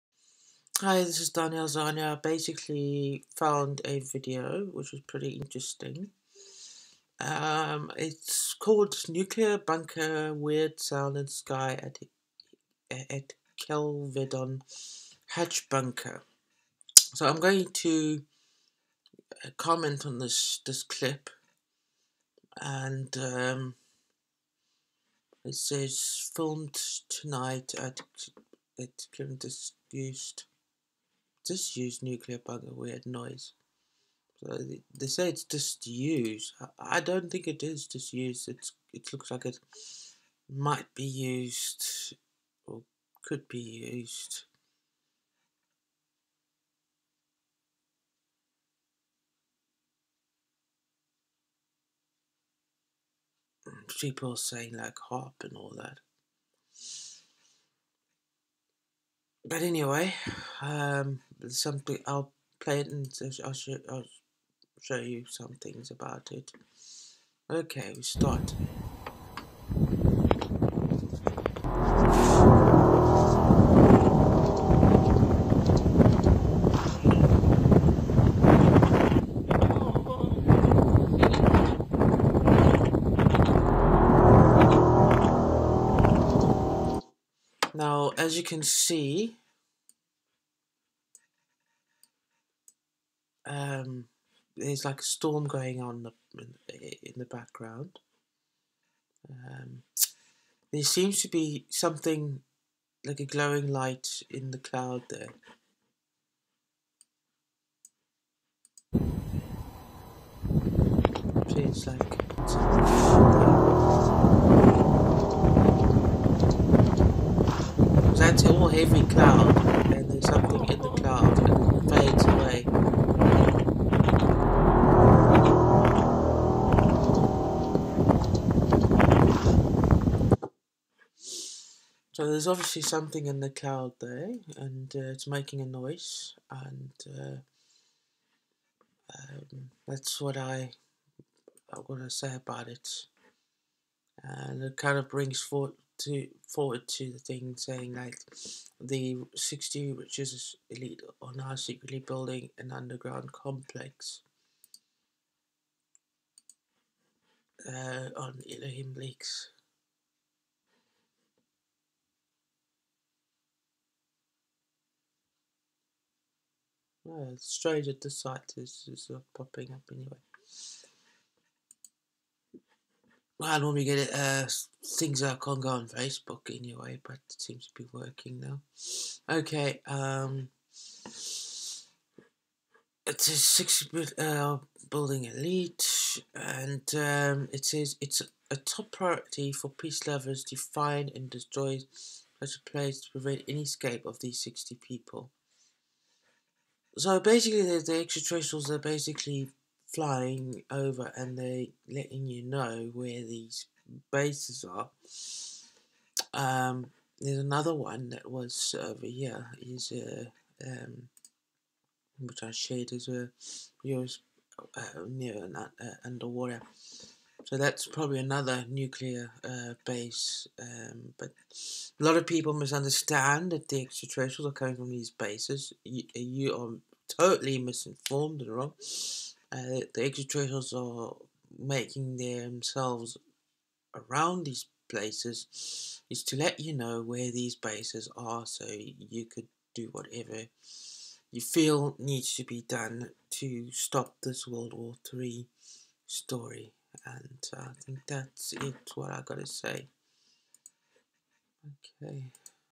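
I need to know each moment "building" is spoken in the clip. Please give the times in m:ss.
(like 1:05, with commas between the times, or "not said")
2:32, 3:04.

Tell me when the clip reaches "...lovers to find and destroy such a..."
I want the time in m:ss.
3:10.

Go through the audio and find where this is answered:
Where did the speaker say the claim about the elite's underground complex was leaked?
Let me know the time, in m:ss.
2:38.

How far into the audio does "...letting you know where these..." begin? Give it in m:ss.
3:21.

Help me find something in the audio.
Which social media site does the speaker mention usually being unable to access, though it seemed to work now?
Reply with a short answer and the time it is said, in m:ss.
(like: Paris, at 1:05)
Facebook, at 2:55.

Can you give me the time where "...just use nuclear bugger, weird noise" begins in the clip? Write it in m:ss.
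0:31.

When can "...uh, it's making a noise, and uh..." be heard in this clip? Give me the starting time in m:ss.
2:14.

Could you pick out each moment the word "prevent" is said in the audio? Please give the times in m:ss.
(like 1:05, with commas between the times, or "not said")
3:13.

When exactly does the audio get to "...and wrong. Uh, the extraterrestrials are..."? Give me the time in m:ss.
3:48.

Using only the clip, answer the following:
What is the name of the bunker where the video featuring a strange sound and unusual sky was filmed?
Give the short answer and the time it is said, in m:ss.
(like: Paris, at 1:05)
Kelvedon Hatch, at 0:13.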